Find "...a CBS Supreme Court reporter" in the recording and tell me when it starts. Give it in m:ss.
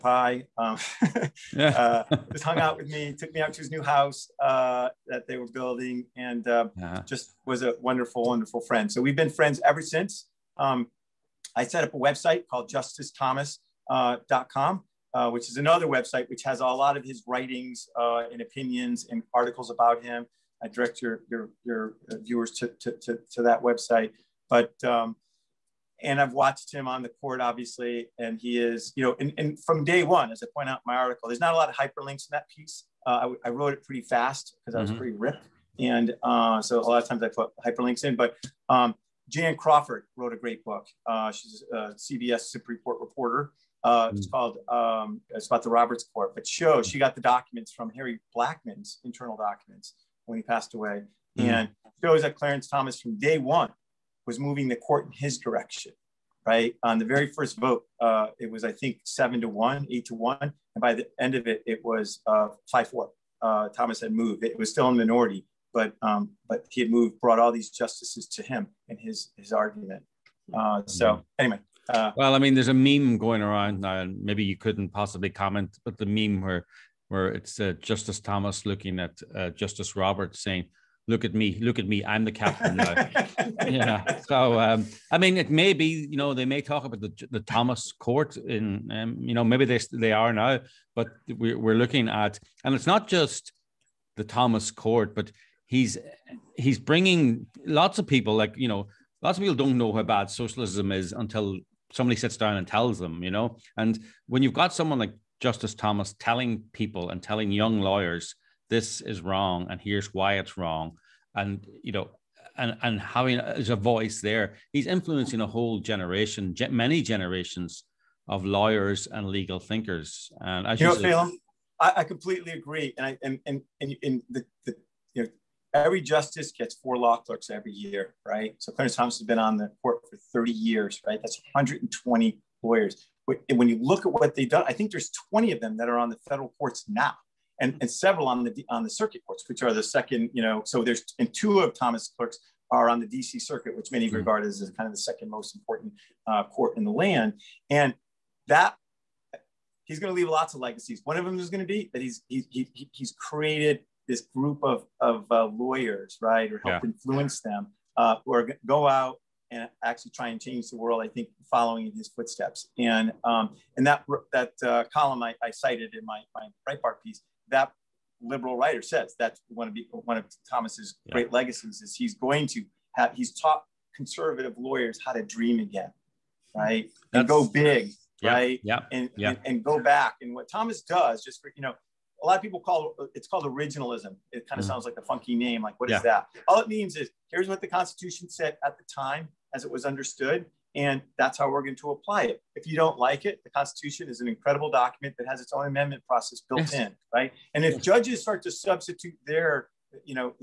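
0:41.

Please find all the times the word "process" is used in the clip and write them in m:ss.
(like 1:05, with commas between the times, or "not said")
3:16.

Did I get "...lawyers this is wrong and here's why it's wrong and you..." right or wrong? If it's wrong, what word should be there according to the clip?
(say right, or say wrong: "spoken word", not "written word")
right.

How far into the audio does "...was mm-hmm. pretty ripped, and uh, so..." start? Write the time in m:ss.
0:34.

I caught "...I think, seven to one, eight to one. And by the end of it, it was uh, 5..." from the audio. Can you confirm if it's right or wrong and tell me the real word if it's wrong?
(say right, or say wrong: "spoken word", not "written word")
right.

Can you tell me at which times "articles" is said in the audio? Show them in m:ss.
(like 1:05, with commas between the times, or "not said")
0:19, 0:30.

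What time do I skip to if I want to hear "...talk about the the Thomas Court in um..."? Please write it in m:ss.
1:26.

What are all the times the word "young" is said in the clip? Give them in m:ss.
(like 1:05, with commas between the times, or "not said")
1:47.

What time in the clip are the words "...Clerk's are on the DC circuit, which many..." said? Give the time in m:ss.
2:22.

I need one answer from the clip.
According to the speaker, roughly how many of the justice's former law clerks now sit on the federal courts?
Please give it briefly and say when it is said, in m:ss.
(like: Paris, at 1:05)
20, at 2:15.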